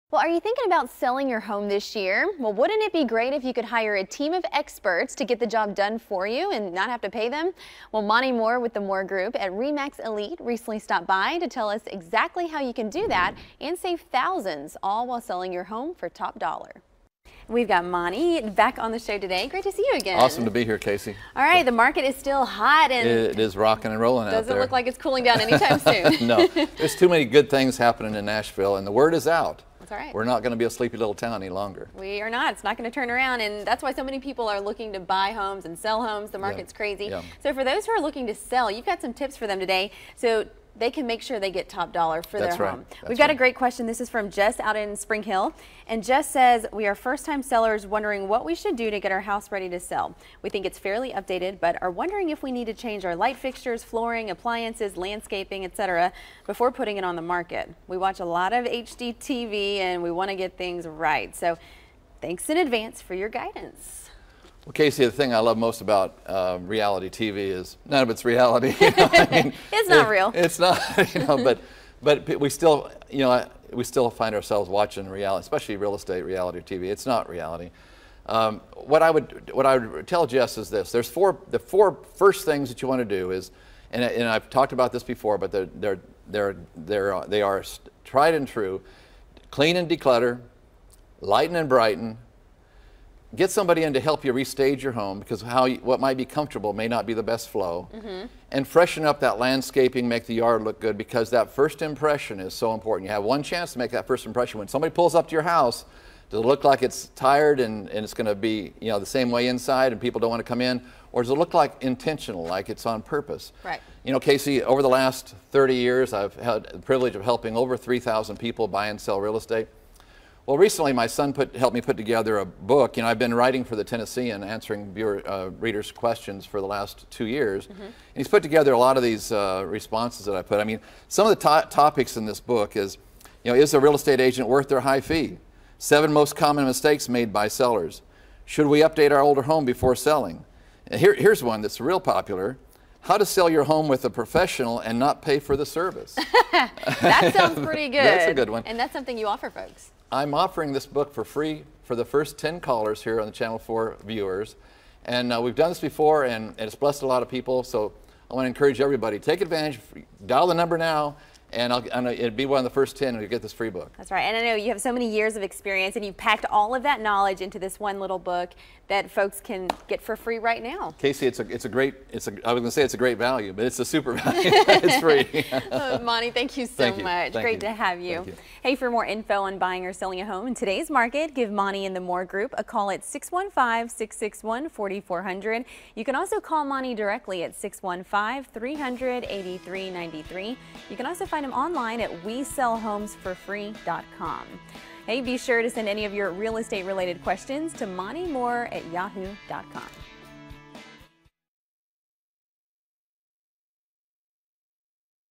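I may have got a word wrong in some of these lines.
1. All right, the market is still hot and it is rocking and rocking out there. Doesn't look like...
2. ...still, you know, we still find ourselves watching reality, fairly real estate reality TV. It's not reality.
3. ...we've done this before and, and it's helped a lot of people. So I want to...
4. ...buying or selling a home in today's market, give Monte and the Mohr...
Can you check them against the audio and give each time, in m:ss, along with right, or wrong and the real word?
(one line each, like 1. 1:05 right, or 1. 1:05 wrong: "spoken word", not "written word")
1. 0:21 wrong: "rolling", not "rocking"
2. 1:12 wrong: "especially", not "fairly"
3. 2:35 wrong: "blessed", not "helped"
4. 2:59 right.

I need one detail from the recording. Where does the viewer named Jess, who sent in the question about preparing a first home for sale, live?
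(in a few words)
Spring Hill.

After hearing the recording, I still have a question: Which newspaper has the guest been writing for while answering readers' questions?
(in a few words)
The Tennessean.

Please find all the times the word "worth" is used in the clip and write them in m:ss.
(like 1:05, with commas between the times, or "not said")
2:14.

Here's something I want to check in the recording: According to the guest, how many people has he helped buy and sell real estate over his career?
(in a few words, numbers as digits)
3000.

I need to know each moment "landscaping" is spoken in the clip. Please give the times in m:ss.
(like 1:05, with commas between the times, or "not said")
0:54, 1:39.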